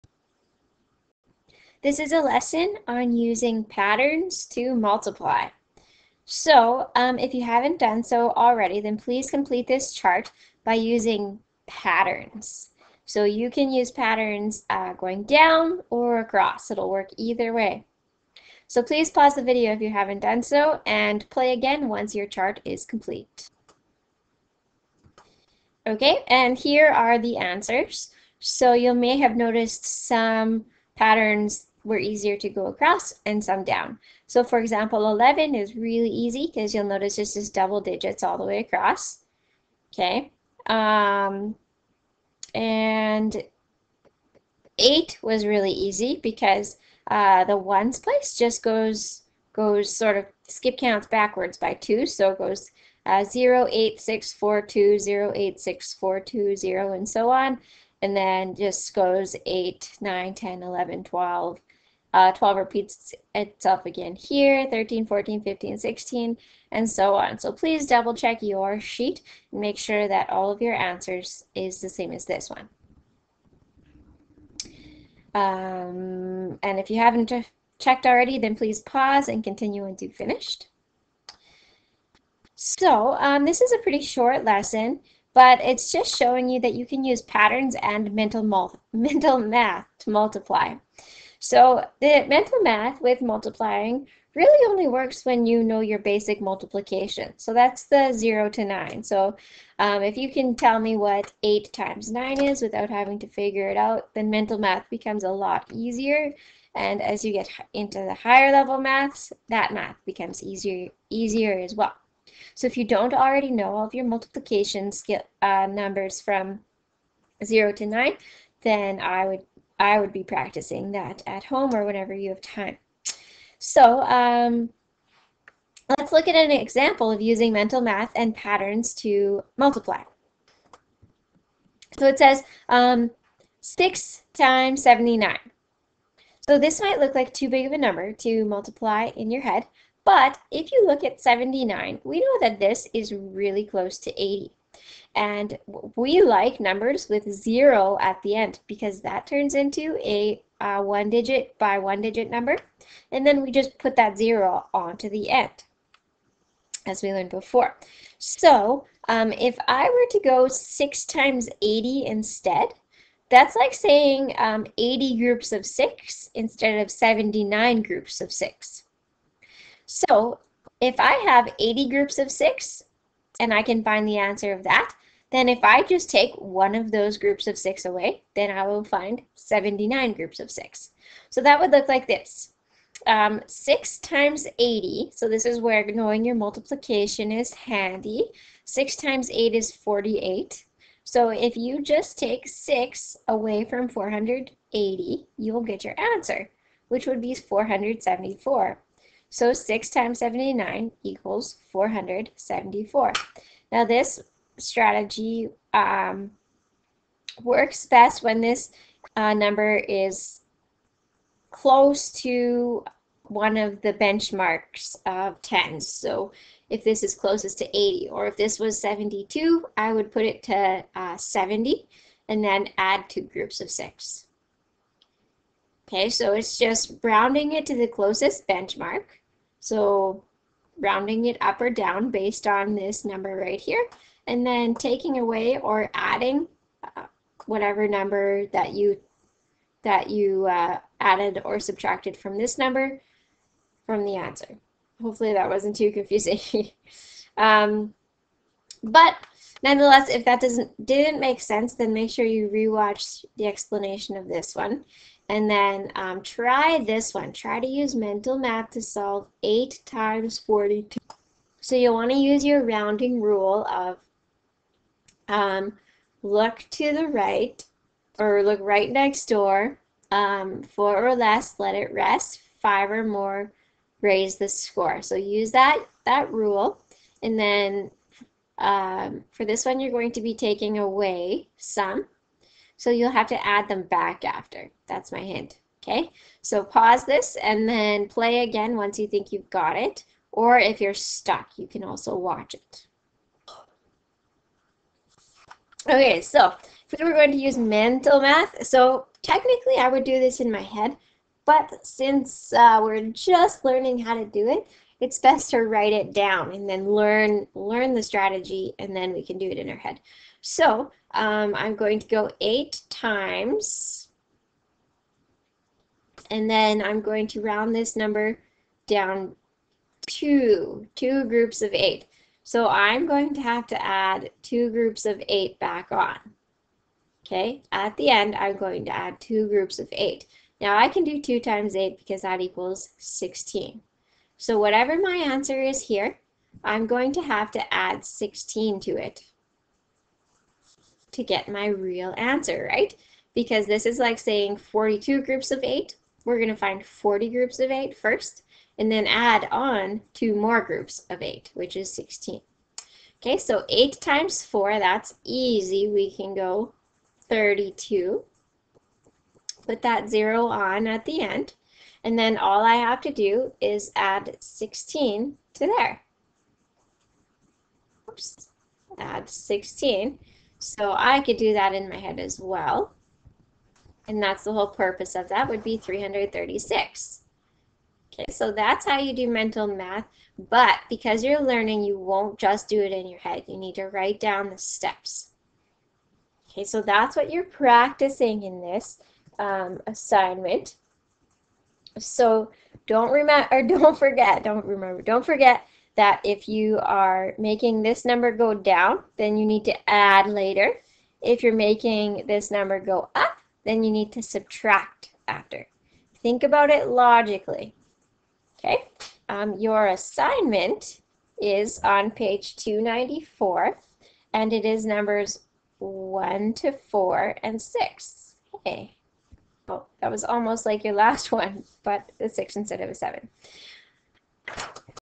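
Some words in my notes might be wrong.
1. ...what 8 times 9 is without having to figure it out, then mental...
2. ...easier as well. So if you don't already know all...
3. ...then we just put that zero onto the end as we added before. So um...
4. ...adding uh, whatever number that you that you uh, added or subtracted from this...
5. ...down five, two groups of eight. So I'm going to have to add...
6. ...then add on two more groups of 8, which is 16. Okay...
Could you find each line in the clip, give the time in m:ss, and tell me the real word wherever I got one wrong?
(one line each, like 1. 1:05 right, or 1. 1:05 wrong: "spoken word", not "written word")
1. 1:40 right
2. 1:51 right
3. 2:33 wrong: "learned", not "added"
4. 3:55 right
5. 5:18 wrong: "two", not "five"
6. 5:48 right.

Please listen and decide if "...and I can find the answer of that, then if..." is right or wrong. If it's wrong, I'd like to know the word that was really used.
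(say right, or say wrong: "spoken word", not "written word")
right.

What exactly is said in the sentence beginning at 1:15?
Um, and if you haven't checked already, then please pause and continue until finished.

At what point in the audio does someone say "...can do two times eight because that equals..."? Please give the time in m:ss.
5:30.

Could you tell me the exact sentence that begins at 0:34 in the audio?
So for example, 11 is really easy because you'll notice it's just double digits all the way across.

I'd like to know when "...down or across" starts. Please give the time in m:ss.
0:15.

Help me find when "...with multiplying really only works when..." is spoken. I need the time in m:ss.
1:33.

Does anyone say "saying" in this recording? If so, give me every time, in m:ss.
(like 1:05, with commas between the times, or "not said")
2:43, 5:44.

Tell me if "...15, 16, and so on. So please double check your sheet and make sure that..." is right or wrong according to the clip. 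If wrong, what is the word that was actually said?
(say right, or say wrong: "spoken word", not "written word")
right.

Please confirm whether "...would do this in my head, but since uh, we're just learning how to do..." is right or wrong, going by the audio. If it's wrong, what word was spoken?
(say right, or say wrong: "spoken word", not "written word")
right.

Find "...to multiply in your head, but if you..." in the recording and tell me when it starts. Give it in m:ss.
2:18.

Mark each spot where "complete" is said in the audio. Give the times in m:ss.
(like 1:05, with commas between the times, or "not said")
0:09, 0:22.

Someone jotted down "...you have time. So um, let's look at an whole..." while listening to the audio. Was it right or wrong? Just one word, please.
wrong.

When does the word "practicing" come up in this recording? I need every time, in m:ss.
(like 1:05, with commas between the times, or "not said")
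2:00, 6:27.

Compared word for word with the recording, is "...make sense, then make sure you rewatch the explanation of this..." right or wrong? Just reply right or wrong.
right.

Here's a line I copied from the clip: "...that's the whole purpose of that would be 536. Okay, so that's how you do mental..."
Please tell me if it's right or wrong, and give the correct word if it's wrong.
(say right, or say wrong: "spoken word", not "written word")
wrong: "336", not "536".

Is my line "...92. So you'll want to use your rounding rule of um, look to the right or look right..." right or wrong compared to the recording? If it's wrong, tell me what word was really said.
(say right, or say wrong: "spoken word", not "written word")
wrong: "42", not "92".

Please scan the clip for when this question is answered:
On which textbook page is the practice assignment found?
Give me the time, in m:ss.
6:52.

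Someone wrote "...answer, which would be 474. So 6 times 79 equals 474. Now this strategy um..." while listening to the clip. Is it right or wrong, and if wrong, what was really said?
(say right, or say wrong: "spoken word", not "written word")
right.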